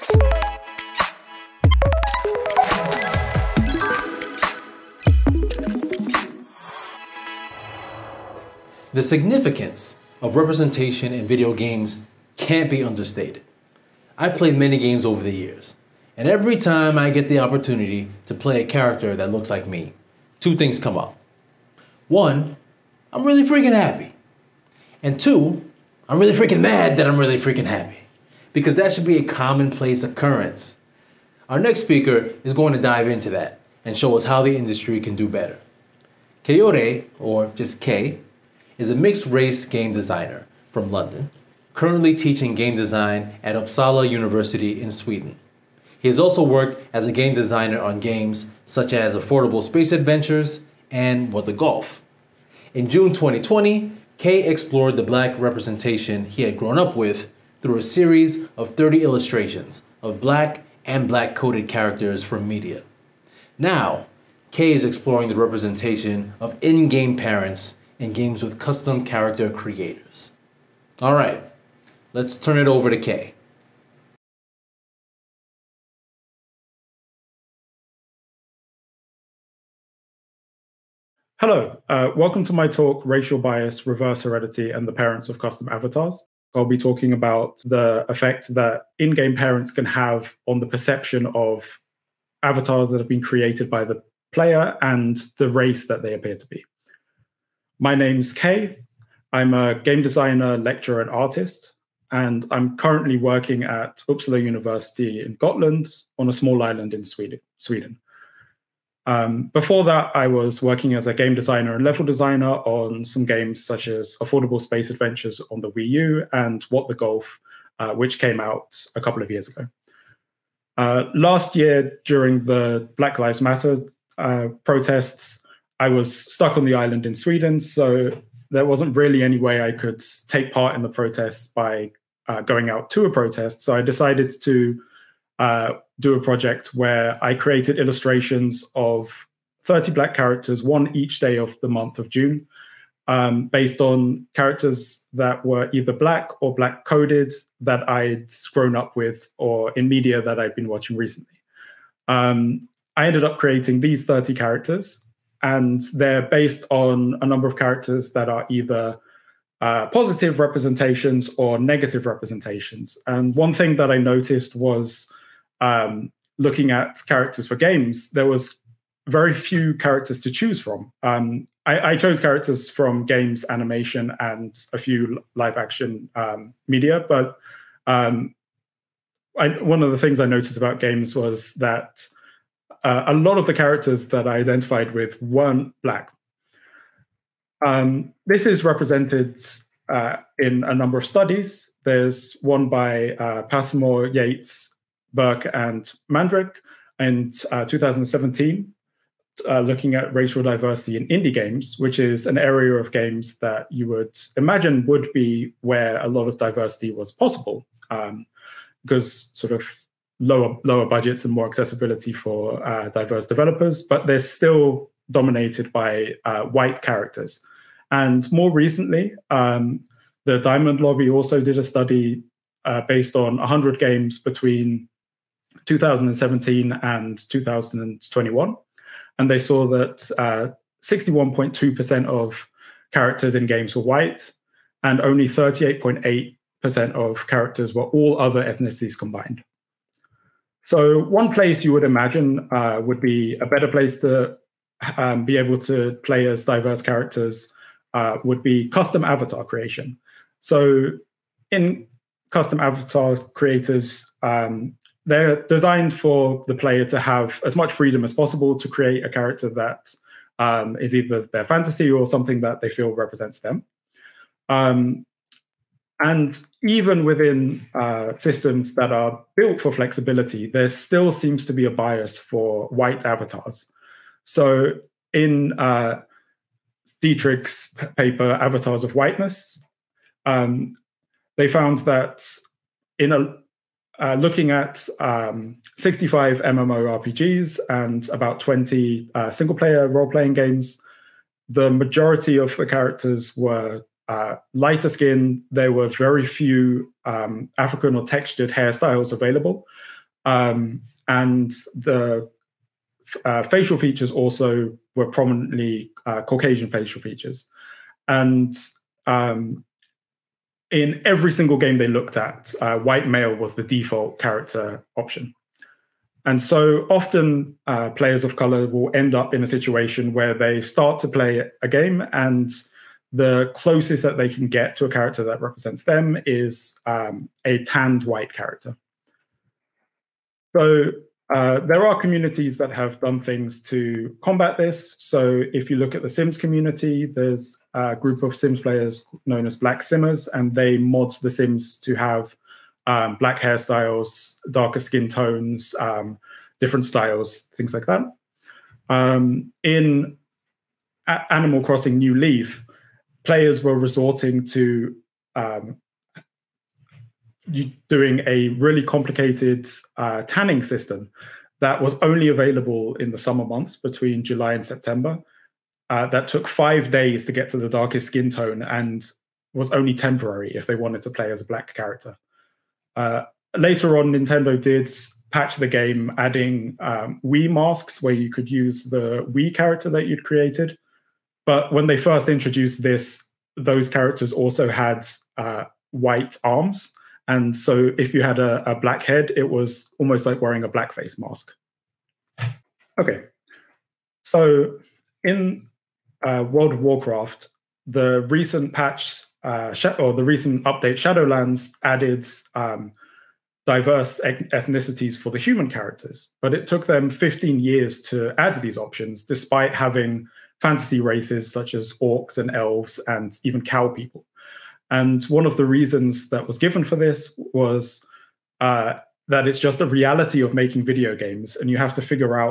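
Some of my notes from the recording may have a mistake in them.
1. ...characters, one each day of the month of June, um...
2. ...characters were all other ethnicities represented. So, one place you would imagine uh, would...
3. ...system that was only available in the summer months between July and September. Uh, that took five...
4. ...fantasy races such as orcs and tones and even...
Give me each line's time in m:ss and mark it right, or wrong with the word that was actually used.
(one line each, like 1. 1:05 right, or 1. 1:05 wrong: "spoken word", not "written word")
1. 2:20 right
2. 3:57 wrong: "combined", not "represented"
3. 6:00 right
4. 6:50 wrong: "elves", not "tones".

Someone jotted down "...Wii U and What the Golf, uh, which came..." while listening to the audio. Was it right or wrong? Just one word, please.
right.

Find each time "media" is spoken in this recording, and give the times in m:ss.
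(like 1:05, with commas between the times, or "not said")
1:02, 2:29, 2:56.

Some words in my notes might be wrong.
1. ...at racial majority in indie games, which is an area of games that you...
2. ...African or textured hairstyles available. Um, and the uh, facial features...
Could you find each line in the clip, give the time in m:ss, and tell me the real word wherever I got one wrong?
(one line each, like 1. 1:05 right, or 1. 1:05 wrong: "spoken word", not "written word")
1. 3:19 wrong: "diversity", not "majority"
2. 4:57 right.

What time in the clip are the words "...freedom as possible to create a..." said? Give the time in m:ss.
4:17.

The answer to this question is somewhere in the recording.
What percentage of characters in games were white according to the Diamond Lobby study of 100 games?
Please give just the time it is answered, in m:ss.
3:50.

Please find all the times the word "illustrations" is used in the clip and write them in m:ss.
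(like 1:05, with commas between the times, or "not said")
0:59, 2:17.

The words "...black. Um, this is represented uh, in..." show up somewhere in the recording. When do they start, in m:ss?
3:05.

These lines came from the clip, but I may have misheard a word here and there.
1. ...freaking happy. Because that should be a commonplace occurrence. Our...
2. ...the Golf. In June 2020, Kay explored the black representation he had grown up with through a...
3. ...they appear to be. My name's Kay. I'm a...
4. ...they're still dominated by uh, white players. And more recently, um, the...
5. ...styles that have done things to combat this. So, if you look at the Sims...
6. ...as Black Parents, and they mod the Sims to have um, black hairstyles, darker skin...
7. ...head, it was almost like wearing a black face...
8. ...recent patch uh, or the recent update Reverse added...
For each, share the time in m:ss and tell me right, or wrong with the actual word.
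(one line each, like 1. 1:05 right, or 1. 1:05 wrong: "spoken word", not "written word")
1. 0:27 right
2. 0:51 right
3. 1:36 right
4. 3:34 wrong: "characters", not "players"
5. 5:31 wrong: "communities", not "styles"
6. 5:39 wrong: "Simmers", not "Parents"
7. 6:29 right
8. 6:38 wrong: "Shadowlands", not "Reverse".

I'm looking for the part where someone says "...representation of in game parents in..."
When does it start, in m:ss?
1:05.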